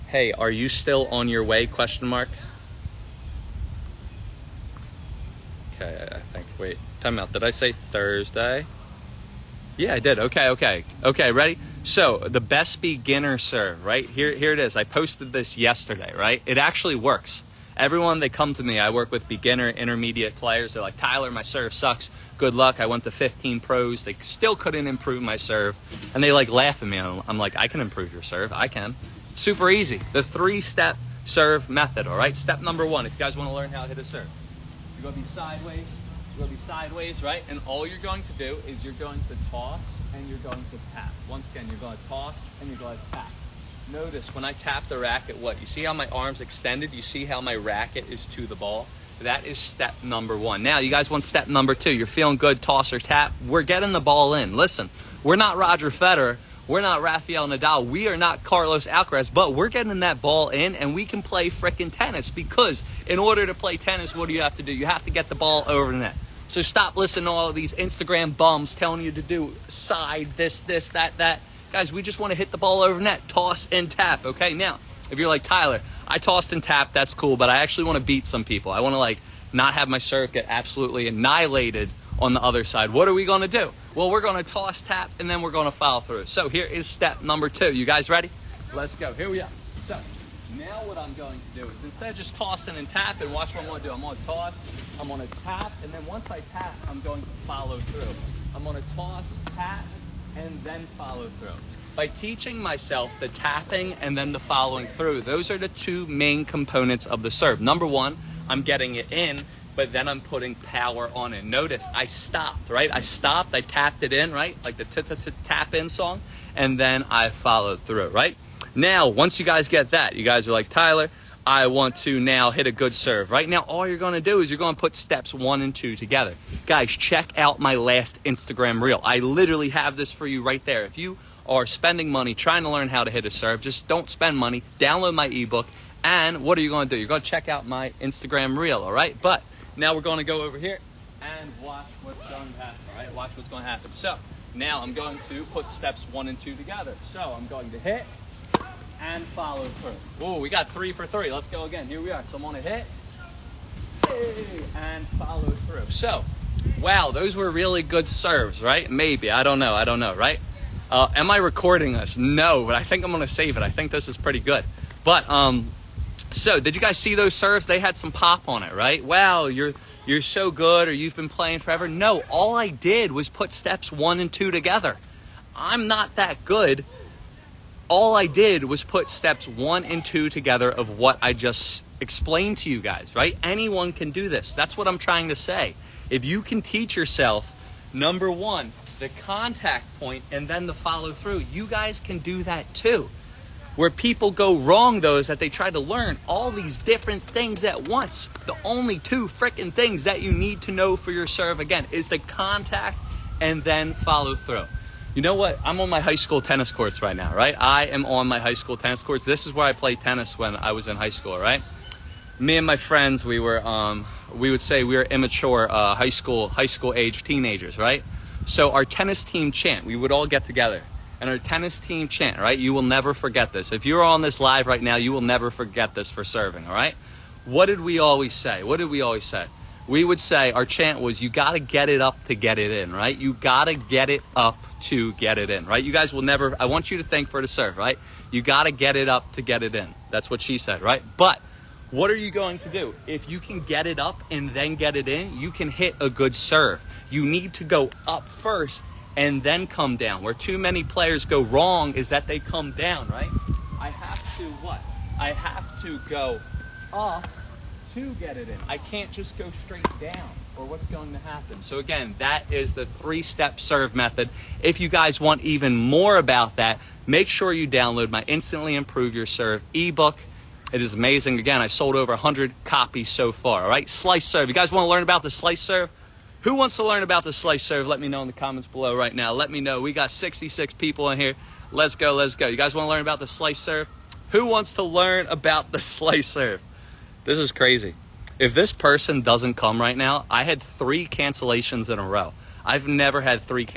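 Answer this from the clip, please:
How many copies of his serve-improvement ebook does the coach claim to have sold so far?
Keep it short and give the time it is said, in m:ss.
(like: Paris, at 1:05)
over 100, at 4:31.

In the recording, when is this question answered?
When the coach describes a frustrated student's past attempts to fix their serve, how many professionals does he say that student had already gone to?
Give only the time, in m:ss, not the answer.
0:23.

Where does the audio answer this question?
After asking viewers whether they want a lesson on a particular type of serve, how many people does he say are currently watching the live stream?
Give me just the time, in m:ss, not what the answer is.
4:40.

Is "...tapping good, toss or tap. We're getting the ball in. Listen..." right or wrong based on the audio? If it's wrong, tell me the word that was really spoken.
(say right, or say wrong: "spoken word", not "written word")
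wrong: "feeling", not "tapping".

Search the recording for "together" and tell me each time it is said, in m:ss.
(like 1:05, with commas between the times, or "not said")
2:05, 2:26, 2:54, 3:00, 3:40.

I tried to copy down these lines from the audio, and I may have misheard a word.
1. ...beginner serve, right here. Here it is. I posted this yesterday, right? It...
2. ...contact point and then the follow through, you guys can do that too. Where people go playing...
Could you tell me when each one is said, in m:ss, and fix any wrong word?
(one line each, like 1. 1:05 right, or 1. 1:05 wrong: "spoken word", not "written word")
1. 0:12 right
2. 3:09 wrong: "wrong", not "playing".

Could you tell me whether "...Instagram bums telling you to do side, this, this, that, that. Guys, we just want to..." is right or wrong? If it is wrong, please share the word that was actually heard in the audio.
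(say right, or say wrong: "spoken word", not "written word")
right.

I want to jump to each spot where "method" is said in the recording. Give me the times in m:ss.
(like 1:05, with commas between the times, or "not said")
0:31, 4:23.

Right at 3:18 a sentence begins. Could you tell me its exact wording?
The only two freaking things that you need to know for your serve, again, is the contact and then follow through.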